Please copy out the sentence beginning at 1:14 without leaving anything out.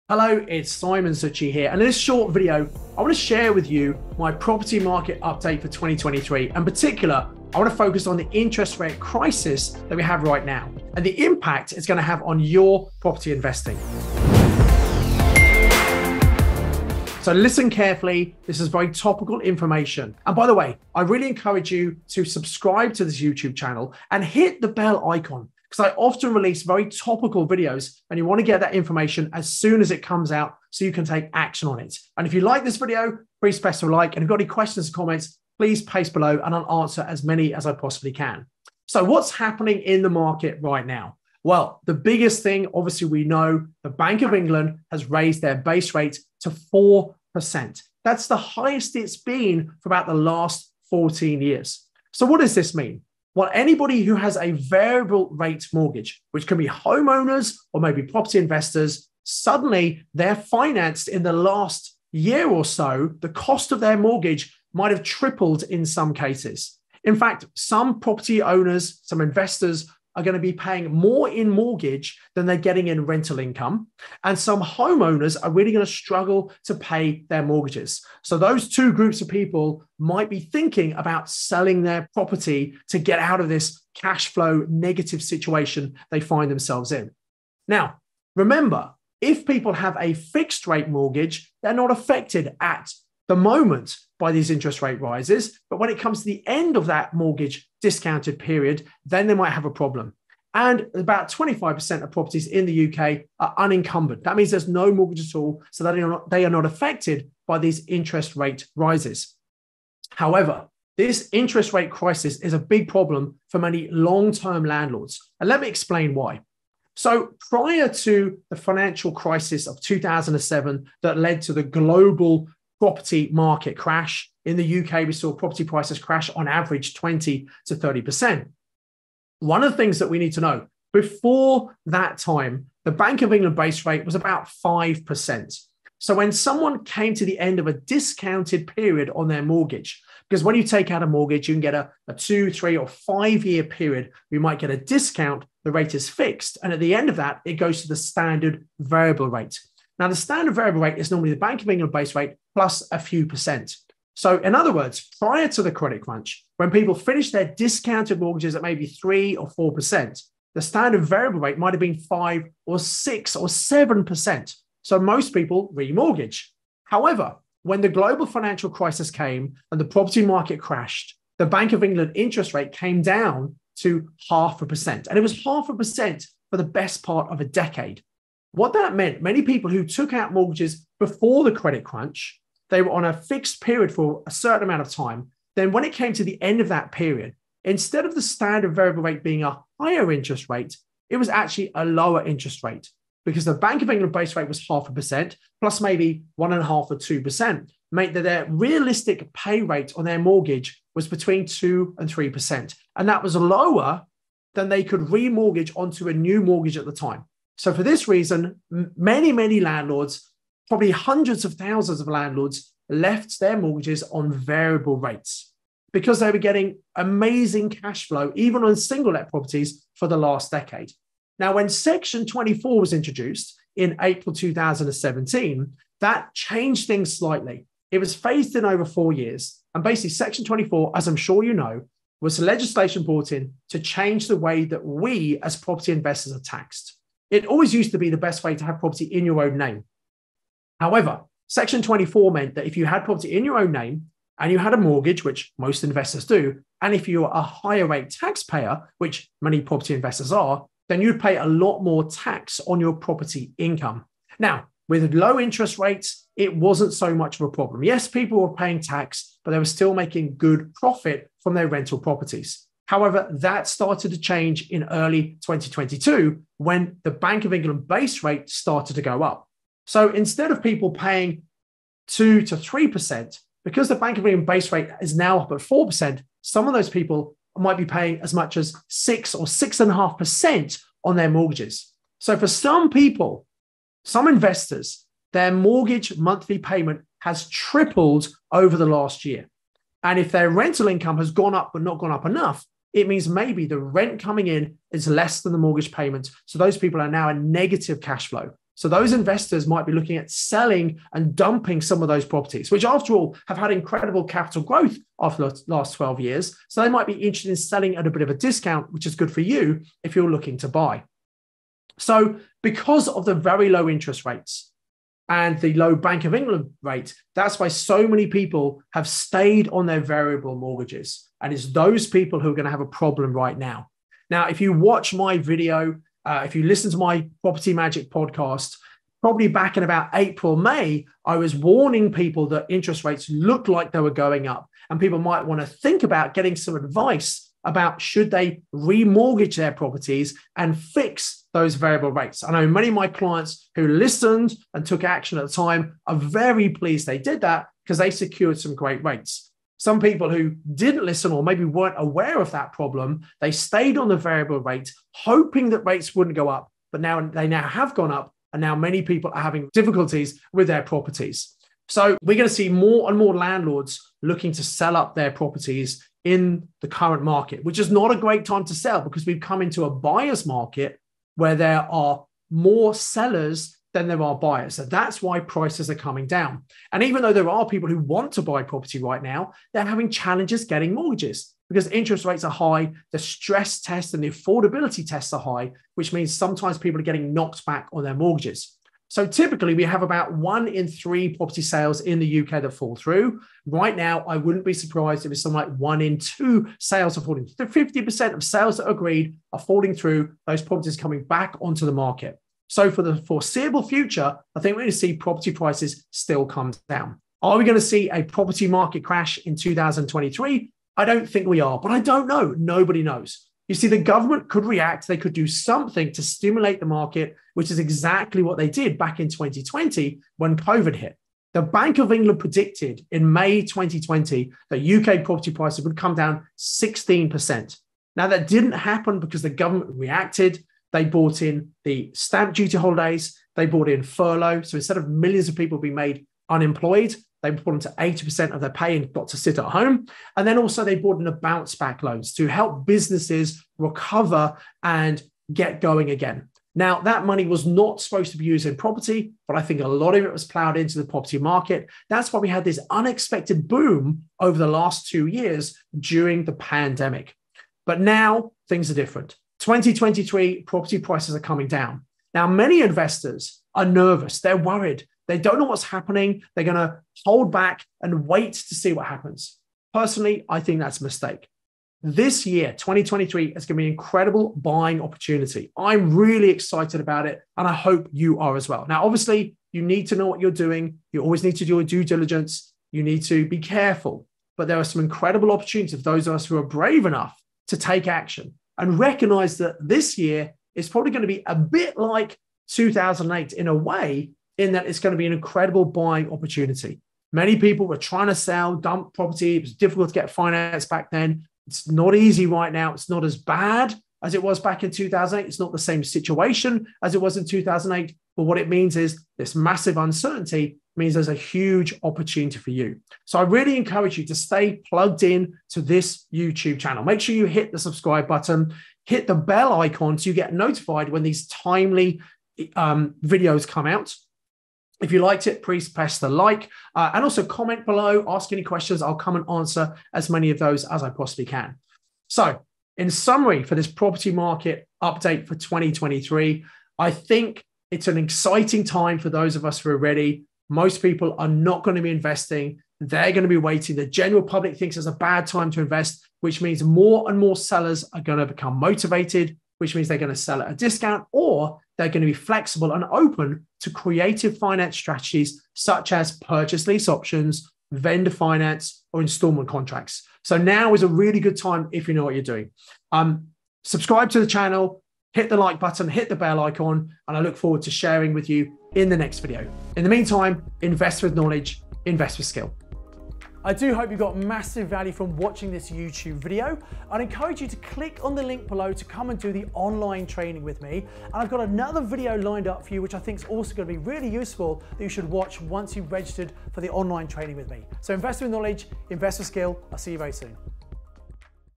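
And some homeowners are really going to struggle to pay their mortgages.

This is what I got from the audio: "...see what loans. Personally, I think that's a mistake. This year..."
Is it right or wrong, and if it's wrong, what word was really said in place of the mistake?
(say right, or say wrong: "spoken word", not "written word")
wrong: "happens", not "loans".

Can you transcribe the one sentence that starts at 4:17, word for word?
Yes, people were paying tax, but they were still making good profit from their rental properties.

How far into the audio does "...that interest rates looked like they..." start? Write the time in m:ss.
5:32.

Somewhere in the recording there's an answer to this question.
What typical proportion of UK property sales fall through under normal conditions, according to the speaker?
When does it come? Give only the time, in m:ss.
6:30.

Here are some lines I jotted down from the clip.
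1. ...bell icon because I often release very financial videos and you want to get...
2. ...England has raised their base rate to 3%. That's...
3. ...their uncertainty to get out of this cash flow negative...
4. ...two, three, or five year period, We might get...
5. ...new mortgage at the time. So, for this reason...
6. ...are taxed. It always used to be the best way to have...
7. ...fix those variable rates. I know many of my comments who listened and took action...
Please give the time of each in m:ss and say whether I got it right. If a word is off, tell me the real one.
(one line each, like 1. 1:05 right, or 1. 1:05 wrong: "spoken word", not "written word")
1. 0:24 wrong: "topical", not "financial"
2. 0:44 wrong: "4", not "3"
3. 1:21 wrong: "property", not "uncertainty"
4. 2:22 right
5. 3:26 right
6. 3:56 right
7. 5:40 wrong: "clients", not "comments".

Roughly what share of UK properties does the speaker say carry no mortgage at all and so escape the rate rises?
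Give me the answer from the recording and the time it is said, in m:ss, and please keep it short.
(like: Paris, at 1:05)
25%, at 1:41.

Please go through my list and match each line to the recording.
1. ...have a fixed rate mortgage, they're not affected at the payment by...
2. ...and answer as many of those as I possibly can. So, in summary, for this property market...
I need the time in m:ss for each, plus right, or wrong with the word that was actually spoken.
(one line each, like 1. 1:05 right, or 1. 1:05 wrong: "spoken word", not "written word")
1. 1:29 wrong: "moment", not "payment"
2. 8:49 right.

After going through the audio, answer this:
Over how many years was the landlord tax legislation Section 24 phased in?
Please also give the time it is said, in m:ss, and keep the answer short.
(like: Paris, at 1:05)
Four years, at 3:48.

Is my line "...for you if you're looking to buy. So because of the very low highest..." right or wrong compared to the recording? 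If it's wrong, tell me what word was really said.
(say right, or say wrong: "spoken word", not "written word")
wrong: "interest", not "highest".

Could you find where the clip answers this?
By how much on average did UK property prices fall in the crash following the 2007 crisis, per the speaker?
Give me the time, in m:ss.
2:06.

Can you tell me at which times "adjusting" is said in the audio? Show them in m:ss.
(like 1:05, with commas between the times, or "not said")
not said.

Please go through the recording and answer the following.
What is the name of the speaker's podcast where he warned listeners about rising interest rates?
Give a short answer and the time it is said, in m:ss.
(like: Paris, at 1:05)
Property Magic, at 5:27.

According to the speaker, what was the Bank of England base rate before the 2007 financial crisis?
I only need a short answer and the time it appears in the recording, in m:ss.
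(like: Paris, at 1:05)
About 5%, at 2:14.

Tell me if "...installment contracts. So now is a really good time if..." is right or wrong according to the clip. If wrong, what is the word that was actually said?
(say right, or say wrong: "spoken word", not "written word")
right.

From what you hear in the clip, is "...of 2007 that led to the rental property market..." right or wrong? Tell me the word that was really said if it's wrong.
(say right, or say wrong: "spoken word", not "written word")
wrong: "global", not "rental".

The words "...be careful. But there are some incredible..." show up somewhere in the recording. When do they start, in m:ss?
8:03.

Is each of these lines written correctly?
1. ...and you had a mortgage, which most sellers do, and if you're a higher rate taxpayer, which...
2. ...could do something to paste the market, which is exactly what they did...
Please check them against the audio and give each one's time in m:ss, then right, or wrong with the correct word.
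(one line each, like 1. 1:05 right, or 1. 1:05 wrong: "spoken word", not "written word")
1. 4:04 wrong: "investors", not "sellers"
2. 6:55 wrong: "stimulate", not "paste".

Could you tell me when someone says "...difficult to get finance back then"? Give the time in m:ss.
8:19.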